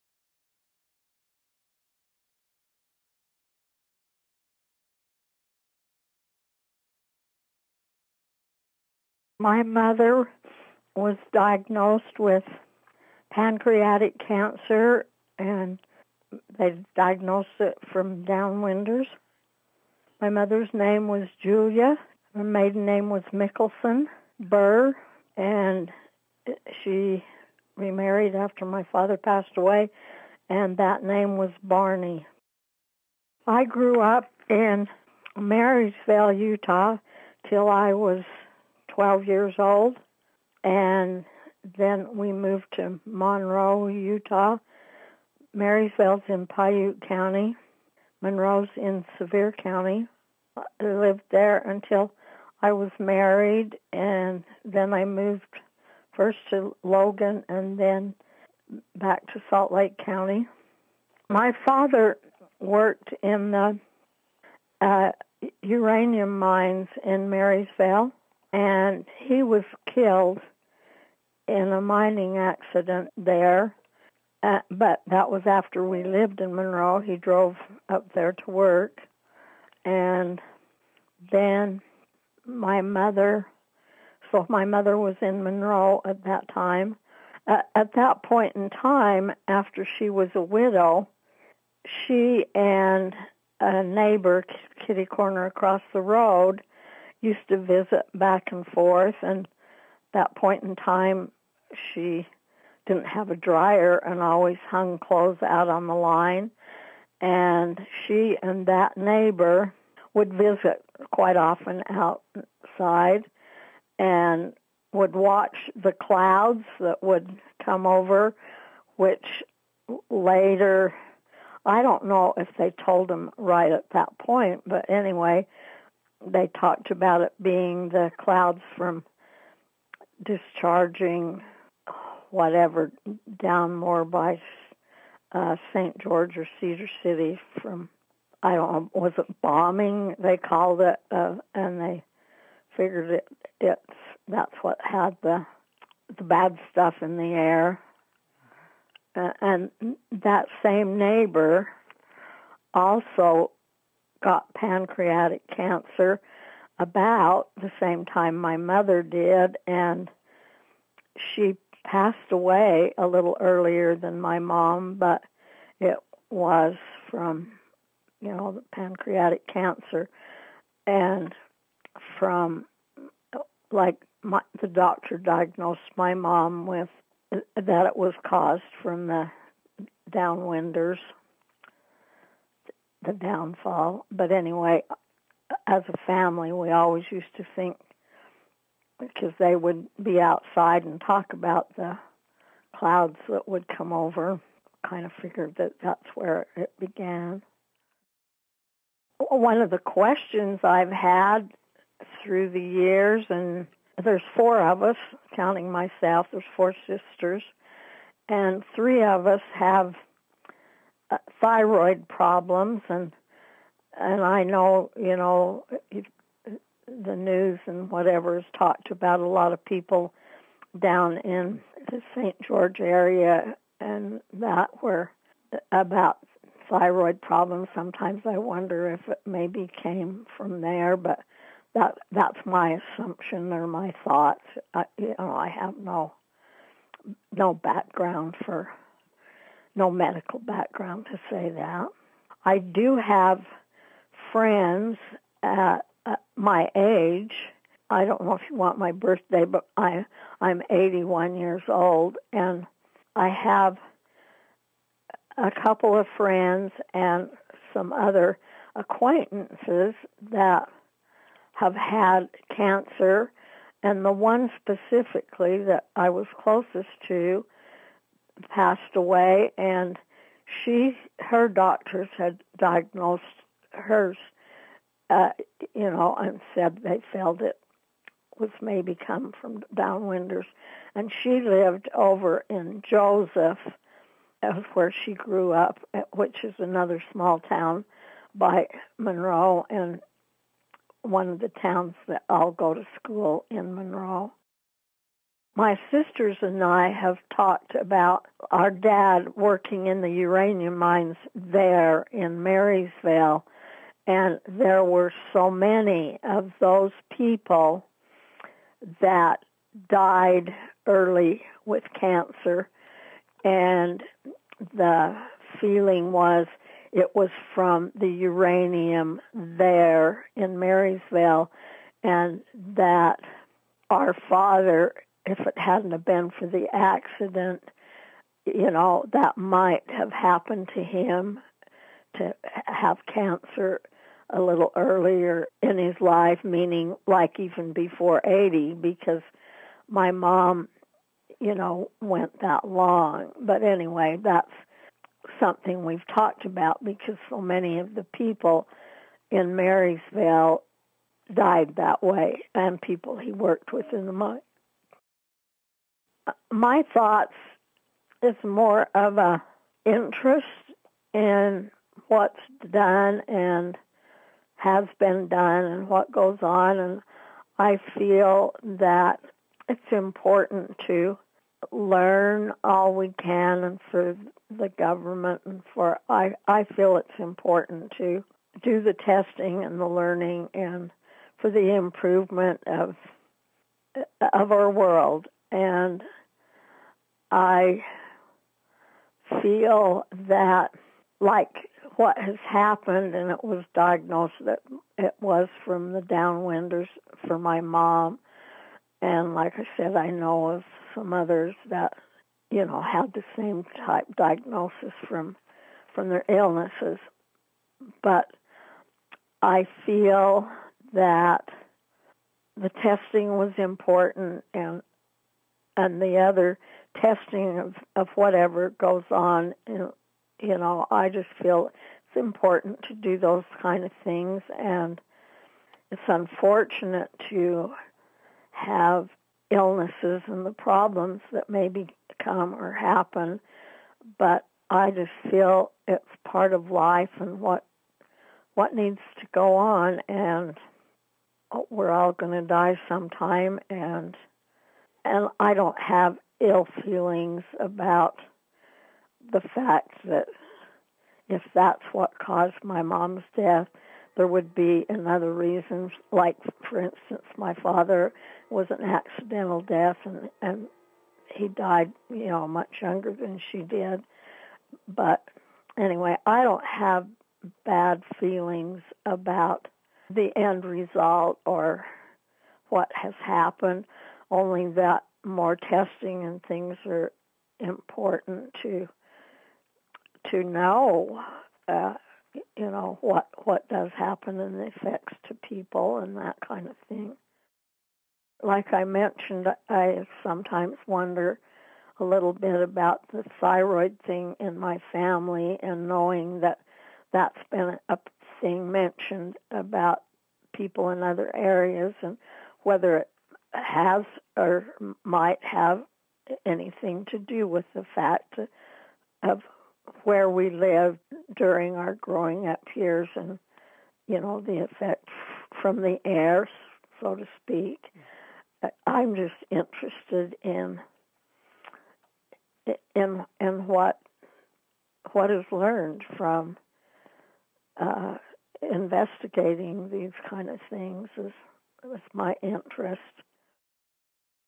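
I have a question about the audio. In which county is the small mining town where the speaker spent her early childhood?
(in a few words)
Piute County.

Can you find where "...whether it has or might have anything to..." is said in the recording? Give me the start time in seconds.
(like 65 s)
502 s.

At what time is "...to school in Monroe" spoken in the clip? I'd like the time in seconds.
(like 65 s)
292 s.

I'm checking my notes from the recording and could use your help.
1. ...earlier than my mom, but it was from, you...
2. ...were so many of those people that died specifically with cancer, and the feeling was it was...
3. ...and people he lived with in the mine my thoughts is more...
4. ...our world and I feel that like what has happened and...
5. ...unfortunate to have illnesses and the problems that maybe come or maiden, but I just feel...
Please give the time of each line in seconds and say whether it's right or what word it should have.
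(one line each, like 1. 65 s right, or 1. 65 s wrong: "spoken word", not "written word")
1. 163 s right
2. 304 s wrong: "early", not "specifically"
3. 352 s wrong: "worked", not "lived"
4. 384 s right
5. 426 s wrong: "happen", not "maiden".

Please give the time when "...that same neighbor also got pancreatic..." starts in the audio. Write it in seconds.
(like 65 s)
150 s.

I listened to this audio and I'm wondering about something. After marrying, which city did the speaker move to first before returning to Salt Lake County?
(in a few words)
Logan.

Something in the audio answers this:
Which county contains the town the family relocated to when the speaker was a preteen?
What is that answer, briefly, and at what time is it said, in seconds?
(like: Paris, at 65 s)
Sevier County, at 49 s.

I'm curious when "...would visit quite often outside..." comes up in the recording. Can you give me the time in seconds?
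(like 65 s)
110 s.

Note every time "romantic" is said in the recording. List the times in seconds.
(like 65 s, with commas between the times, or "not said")
not said.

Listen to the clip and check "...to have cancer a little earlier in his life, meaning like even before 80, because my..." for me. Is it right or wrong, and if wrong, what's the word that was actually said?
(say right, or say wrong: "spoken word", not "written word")
right.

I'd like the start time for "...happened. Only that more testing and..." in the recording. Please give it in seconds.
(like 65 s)
473 s.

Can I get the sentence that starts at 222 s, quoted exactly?
George area and that were about thyroid problems.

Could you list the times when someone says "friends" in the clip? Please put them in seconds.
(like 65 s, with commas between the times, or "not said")
244 s, 256 s.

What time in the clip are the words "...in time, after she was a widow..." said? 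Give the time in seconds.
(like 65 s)
88 s.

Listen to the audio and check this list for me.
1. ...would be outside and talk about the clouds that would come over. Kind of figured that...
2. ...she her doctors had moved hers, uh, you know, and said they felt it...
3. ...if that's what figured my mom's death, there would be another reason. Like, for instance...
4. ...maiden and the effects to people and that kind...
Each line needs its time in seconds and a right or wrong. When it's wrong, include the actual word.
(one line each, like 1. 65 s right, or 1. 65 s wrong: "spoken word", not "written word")
1. 189 s right
2. 270 s wrong: "diagnosed", not "moved"
3. 451 s wrong: "caused", not "figured"
4. 483 s wrong: "happen", not "maiden".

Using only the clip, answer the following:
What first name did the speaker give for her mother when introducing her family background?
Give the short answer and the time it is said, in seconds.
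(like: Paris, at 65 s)
Julia, at 21 s.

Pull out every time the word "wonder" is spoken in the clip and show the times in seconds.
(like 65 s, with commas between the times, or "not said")
228 s, 490 s.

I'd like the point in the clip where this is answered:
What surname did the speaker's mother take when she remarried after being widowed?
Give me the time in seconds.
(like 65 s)
31 s.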